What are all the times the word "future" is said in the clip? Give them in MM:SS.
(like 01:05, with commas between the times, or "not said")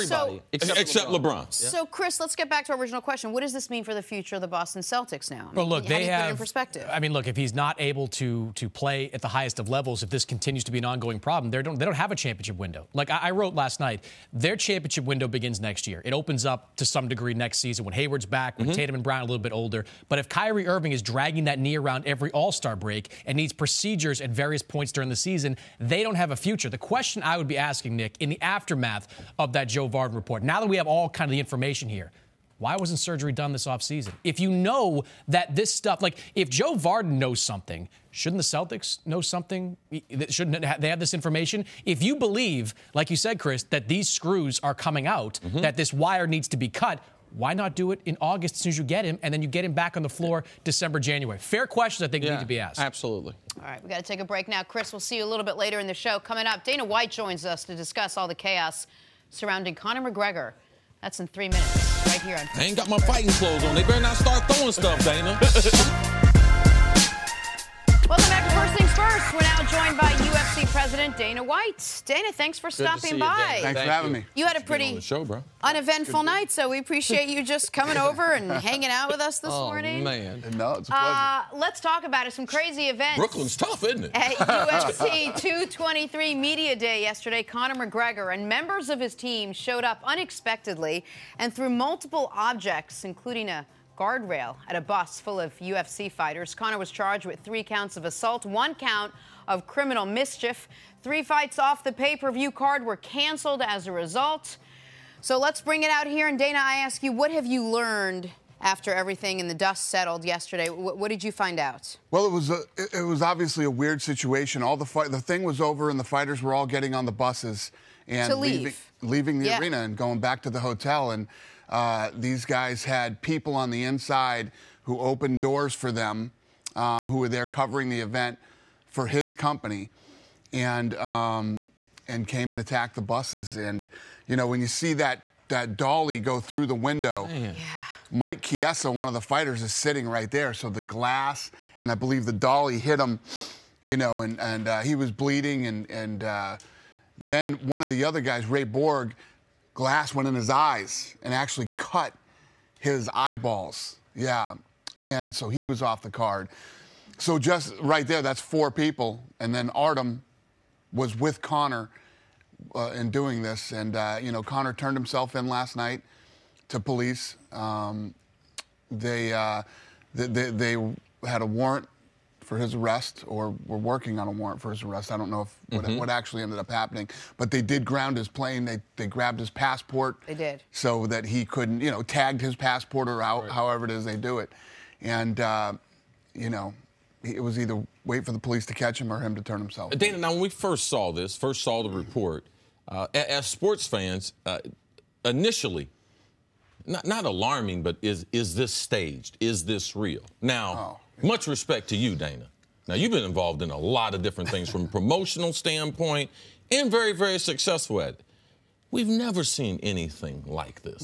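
00:04, 00:26.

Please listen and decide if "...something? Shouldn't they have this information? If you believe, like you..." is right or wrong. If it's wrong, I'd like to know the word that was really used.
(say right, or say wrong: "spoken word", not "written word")
right.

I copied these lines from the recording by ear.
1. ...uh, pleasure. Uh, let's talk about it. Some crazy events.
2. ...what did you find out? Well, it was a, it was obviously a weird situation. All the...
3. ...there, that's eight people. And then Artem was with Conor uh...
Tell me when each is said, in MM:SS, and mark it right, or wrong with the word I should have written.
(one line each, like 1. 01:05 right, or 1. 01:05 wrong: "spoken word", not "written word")
1. 01:20 right
2. 01:50 right
3. 02:38 wrong: "four", not "eight".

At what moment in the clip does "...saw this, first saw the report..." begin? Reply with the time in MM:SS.
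03:10.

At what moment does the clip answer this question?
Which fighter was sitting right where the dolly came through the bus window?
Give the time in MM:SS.
02:18.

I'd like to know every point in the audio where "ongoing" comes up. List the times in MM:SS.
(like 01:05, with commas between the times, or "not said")
00:10.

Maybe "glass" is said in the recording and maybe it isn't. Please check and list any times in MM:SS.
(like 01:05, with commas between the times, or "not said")
02:20, 02:29.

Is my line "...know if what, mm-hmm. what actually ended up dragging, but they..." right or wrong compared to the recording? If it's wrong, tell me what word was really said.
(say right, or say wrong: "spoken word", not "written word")
wrong: "happening", not "dragging".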